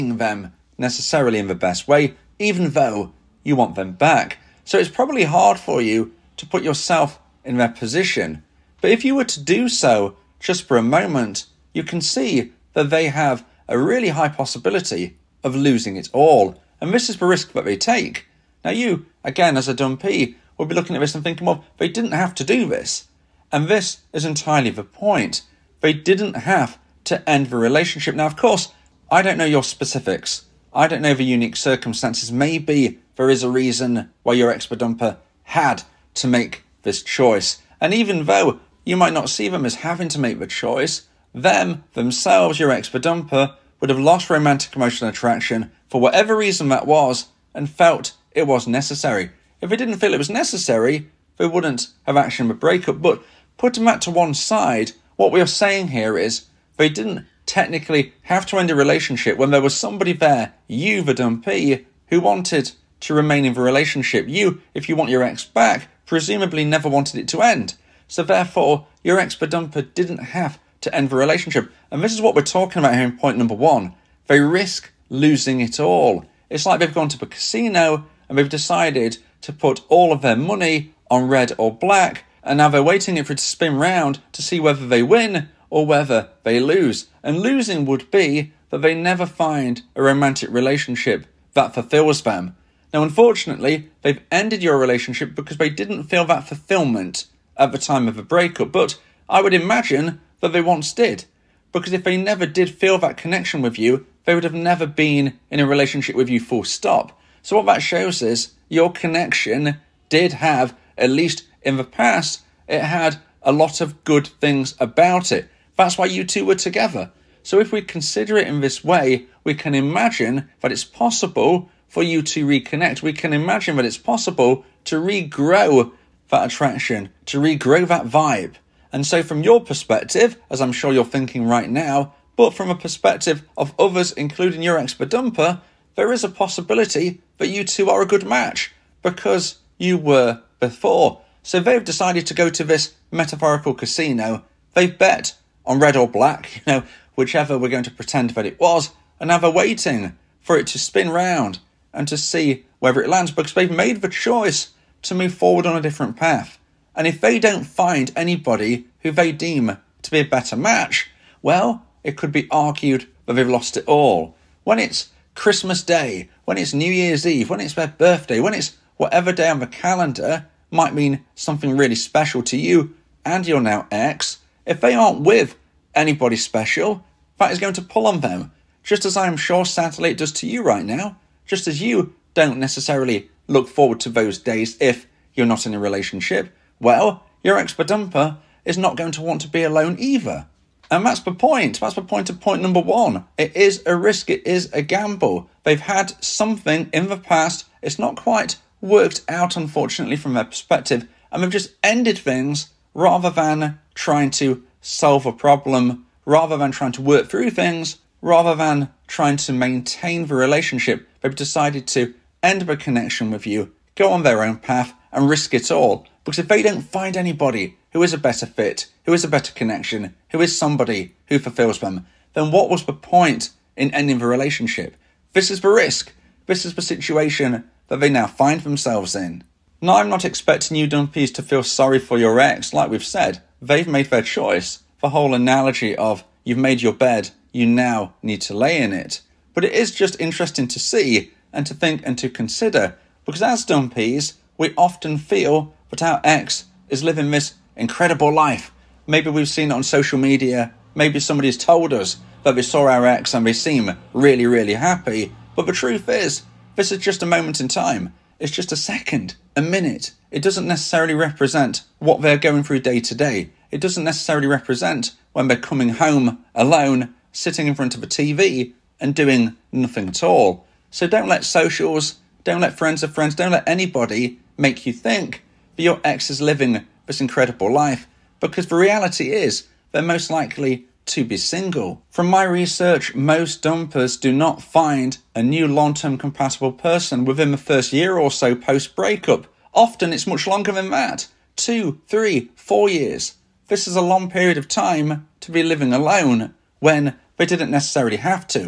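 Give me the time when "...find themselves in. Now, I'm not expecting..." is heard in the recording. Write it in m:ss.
3:48.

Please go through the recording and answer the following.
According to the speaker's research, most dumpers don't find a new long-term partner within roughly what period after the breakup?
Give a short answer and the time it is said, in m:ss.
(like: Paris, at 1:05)
first year, at 4:47.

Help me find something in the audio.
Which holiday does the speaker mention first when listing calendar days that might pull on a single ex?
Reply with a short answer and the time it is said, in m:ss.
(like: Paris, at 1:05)
Christmas Day, at 2:45.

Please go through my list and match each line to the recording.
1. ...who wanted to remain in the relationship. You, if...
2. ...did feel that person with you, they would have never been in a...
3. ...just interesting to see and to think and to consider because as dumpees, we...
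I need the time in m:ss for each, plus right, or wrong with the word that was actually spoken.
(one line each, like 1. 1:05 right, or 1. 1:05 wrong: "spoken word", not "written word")
1. 1:02 right
2. 1:42 wrong: "connection", not "person"
3. 3:59 right.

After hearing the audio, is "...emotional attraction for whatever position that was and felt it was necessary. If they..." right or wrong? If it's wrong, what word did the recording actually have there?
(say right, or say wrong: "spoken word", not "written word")
wrong: "reason", not "position".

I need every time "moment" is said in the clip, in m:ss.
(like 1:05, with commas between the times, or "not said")
0:10, 4:17.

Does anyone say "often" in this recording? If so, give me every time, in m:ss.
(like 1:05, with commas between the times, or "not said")
4:04, 4:49.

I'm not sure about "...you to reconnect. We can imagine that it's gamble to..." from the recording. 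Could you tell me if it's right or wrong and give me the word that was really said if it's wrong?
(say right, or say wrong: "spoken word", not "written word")
wrong: "possible", not "gamble".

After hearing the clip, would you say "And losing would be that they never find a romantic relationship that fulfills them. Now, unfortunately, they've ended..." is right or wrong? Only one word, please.
right.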